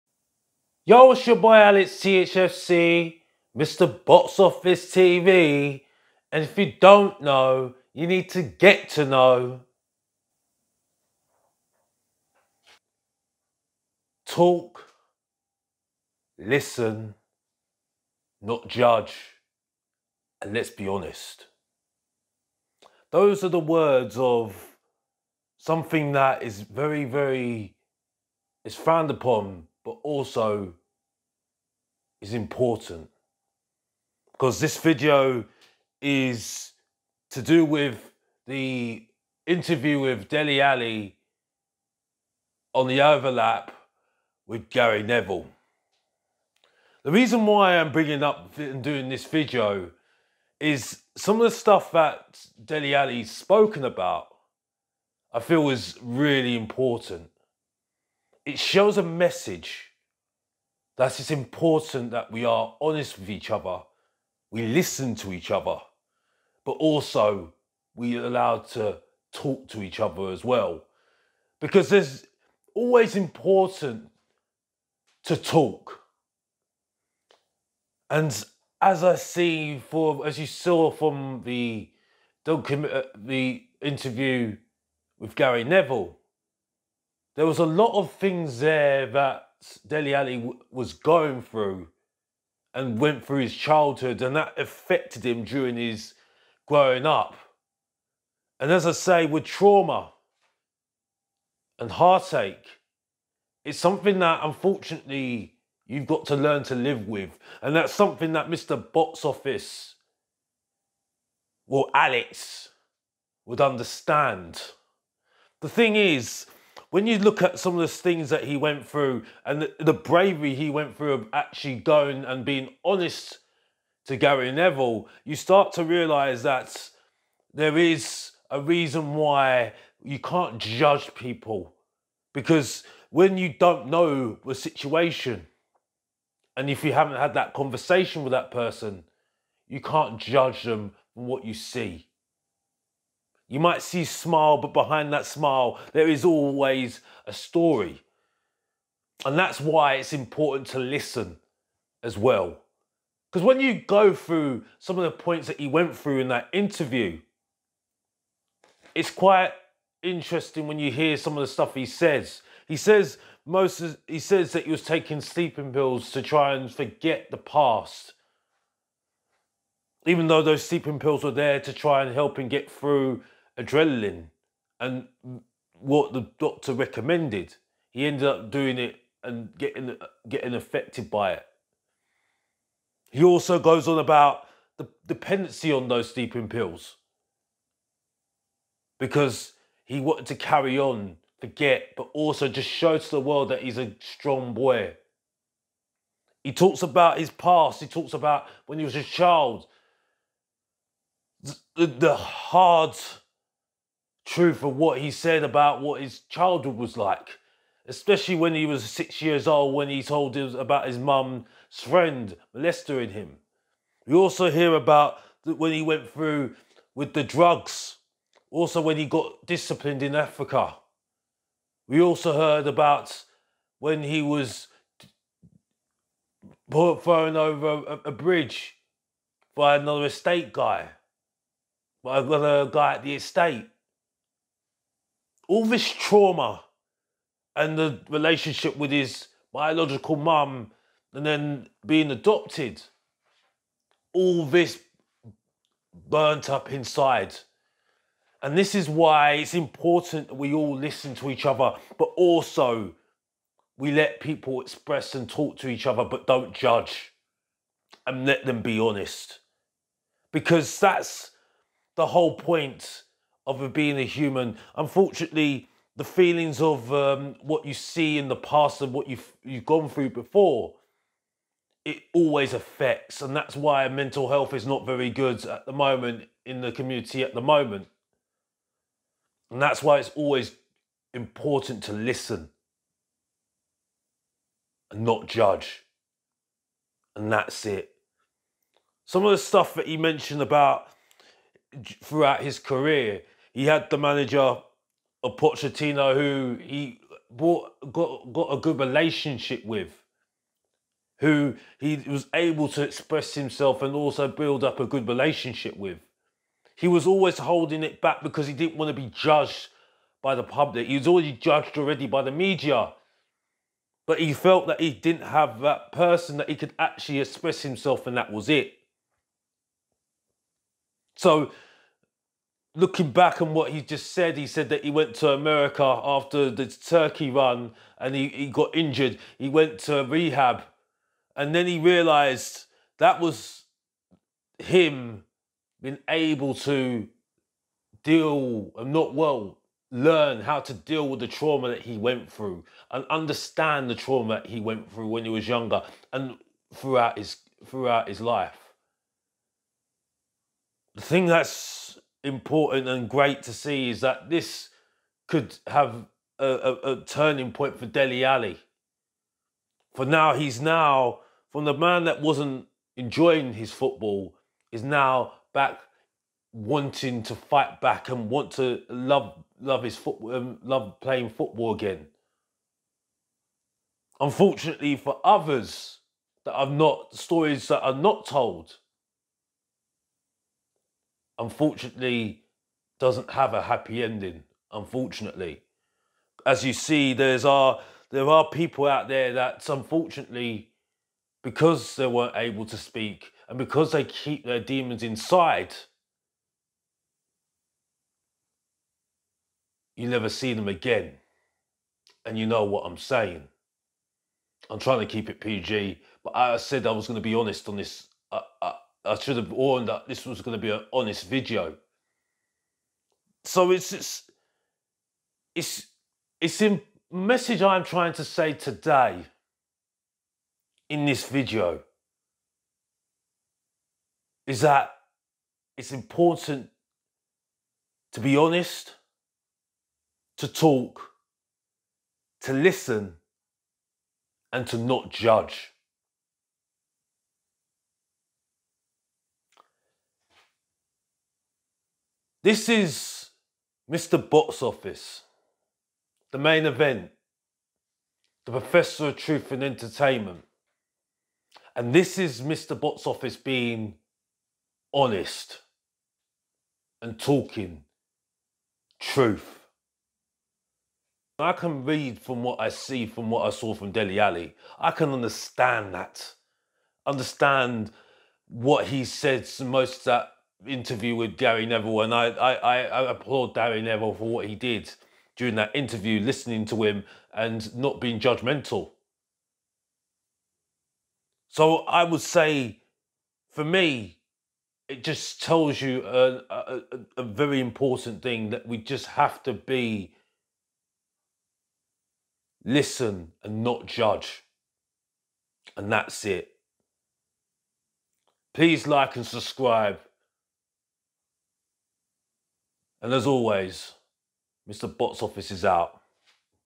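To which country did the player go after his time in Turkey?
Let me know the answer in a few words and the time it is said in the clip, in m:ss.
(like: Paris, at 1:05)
America, at 5:25.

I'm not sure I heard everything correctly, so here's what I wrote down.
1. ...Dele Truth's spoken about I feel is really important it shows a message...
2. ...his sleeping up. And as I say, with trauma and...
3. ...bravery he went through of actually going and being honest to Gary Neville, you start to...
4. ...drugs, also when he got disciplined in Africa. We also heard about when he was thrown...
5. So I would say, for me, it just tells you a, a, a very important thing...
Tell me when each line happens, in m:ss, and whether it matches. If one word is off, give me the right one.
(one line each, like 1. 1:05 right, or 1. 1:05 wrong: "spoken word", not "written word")
1. 0:52 wrong: "Alli", not "Truth"
2. 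1:35 wrong: "growing", not "sleeping"
3. 1:59 right
4. 3:37 right
5. 8:01 right.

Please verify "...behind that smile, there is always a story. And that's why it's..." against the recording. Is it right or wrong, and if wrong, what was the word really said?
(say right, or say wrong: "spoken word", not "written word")
right.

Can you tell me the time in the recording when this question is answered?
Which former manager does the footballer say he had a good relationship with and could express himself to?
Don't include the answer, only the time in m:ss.
4:55.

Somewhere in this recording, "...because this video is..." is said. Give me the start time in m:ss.
0:34.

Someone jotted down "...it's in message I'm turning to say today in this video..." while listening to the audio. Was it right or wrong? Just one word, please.
wrong.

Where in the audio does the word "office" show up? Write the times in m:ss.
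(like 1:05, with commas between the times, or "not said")
0:04, 1:49, 7:24, 7:33, 8:25.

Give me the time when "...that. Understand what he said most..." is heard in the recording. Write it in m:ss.
7:45.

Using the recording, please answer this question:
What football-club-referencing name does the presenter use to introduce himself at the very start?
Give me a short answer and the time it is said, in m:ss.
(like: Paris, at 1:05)
Alex THFC, at 0:01.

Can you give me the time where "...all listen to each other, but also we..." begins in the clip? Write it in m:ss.
4:10.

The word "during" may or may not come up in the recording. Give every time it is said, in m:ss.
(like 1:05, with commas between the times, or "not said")
1:35, 7:55.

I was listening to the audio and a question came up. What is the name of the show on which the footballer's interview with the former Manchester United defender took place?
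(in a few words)
The Overlap.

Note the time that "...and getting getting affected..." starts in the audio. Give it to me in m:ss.
2:59.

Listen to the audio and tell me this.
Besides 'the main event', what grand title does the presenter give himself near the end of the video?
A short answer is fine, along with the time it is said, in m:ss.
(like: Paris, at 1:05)
the professor of truth and entertainment, at 7:28.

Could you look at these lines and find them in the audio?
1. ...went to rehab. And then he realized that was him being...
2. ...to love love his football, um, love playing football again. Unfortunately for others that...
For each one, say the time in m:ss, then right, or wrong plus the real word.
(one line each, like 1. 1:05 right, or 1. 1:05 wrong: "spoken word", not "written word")
1. 5:29 right
2. 6:08 right.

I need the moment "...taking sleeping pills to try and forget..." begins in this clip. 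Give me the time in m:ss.
2:44.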